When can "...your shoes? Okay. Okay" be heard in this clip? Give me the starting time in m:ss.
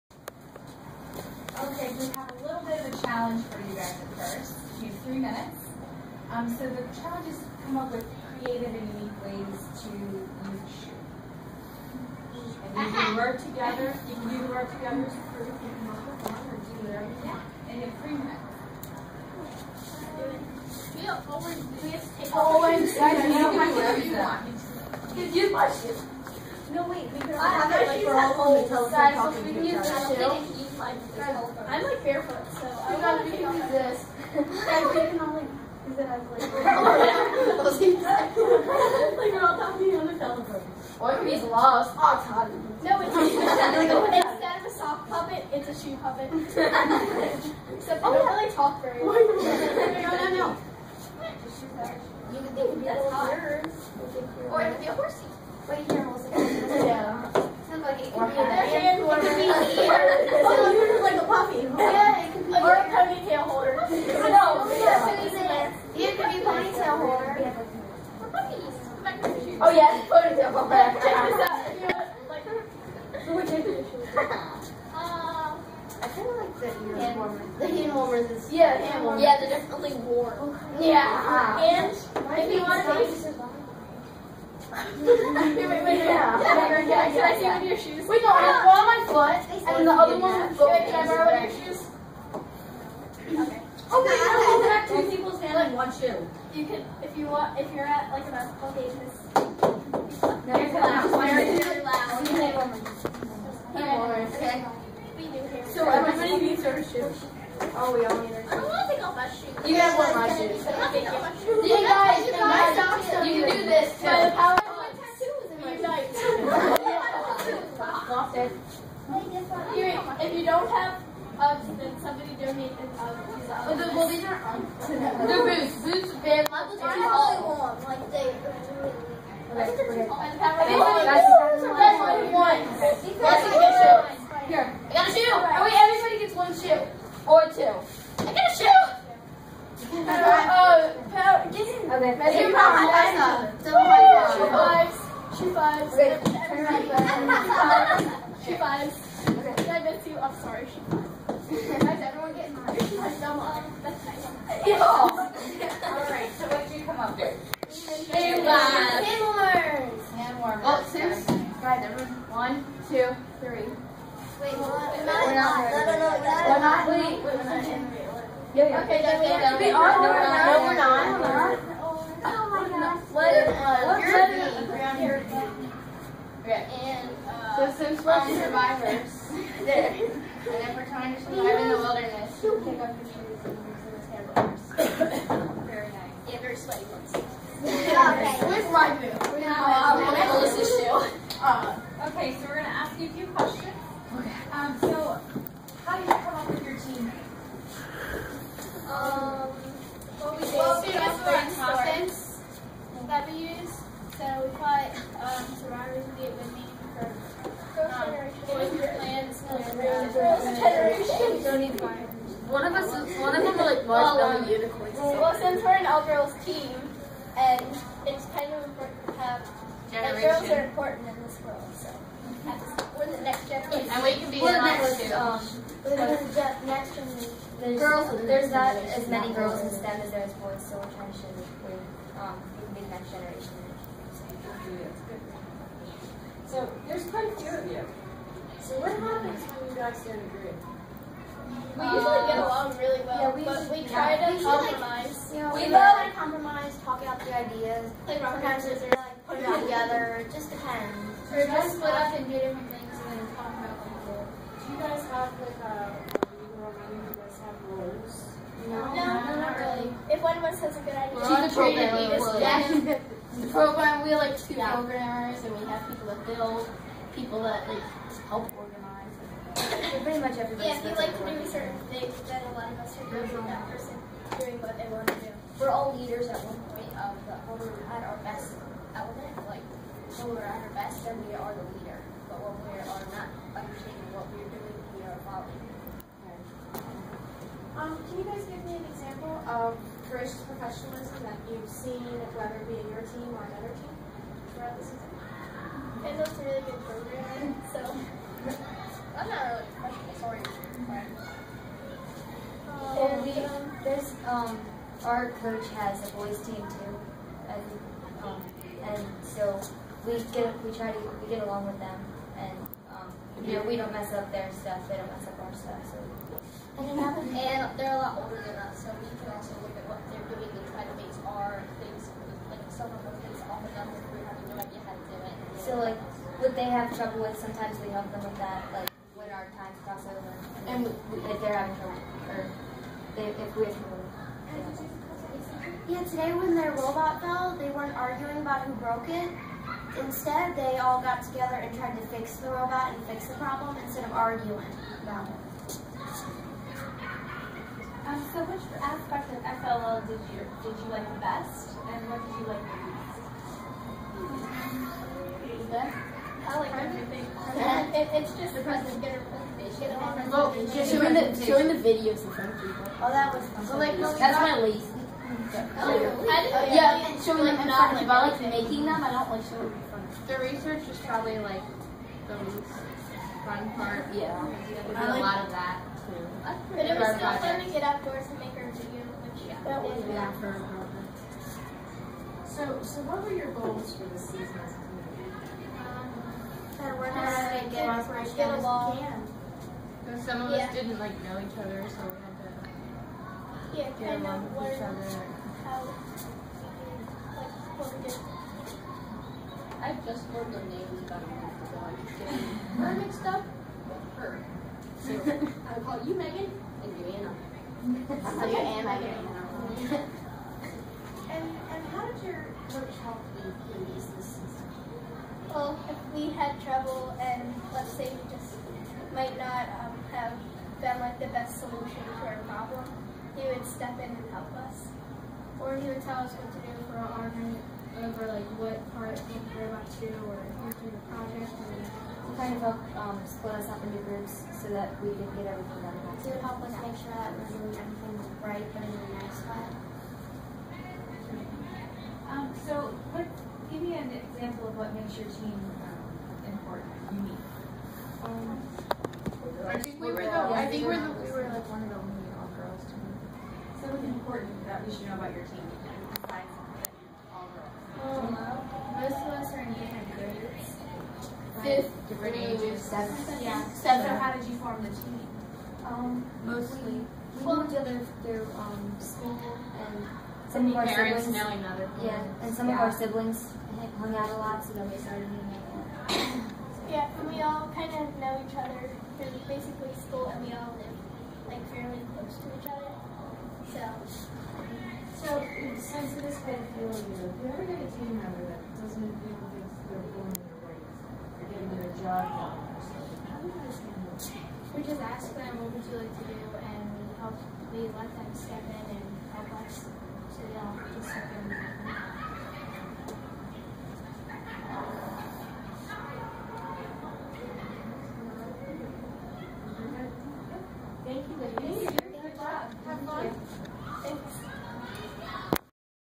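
1:31.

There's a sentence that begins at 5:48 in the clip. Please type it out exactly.
Um, so which aspect of FLL did you, did you like the best, and what did you like the least?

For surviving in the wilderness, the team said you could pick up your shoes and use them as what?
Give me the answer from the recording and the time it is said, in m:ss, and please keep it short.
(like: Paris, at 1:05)
handlebars, at 3:05.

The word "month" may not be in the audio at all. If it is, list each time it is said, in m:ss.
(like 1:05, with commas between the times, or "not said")
6:41.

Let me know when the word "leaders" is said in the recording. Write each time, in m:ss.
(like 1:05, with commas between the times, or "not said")
4:35, 4:41.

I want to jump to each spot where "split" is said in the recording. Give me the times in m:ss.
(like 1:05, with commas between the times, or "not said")
4:11, 7:13.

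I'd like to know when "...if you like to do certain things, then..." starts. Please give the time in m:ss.
4:30.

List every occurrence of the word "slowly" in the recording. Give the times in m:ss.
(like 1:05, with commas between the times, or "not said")
not said.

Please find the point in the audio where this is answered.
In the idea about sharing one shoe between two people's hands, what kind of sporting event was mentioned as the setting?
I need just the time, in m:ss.
1:38.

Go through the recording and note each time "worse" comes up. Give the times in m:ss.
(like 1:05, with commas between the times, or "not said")
not said.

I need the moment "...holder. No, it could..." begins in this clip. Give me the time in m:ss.
1:03.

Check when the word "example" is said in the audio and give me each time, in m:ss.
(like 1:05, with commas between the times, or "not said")
4:48, 7:24.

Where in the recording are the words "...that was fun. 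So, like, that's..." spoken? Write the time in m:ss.
6:03.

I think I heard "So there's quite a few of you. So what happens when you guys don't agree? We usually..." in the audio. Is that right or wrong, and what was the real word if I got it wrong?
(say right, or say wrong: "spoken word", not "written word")
right.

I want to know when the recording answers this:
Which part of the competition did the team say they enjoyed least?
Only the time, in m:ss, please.
6:10.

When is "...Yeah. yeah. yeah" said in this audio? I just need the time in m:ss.
1:25.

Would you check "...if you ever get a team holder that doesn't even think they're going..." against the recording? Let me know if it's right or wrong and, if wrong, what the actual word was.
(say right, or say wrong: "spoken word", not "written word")
wrong: "member", not "holder".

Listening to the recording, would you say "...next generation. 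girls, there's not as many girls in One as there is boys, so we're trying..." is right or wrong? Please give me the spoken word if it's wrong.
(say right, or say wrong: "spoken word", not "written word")
wrong: "STEM", not "One".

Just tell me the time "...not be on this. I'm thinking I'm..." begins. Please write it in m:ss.
0:33.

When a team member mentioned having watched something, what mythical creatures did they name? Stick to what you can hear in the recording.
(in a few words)
unicorns.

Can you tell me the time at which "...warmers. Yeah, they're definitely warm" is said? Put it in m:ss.
1:19.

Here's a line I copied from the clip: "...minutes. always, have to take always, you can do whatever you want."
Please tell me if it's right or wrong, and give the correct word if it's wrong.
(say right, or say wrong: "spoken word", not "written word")
right.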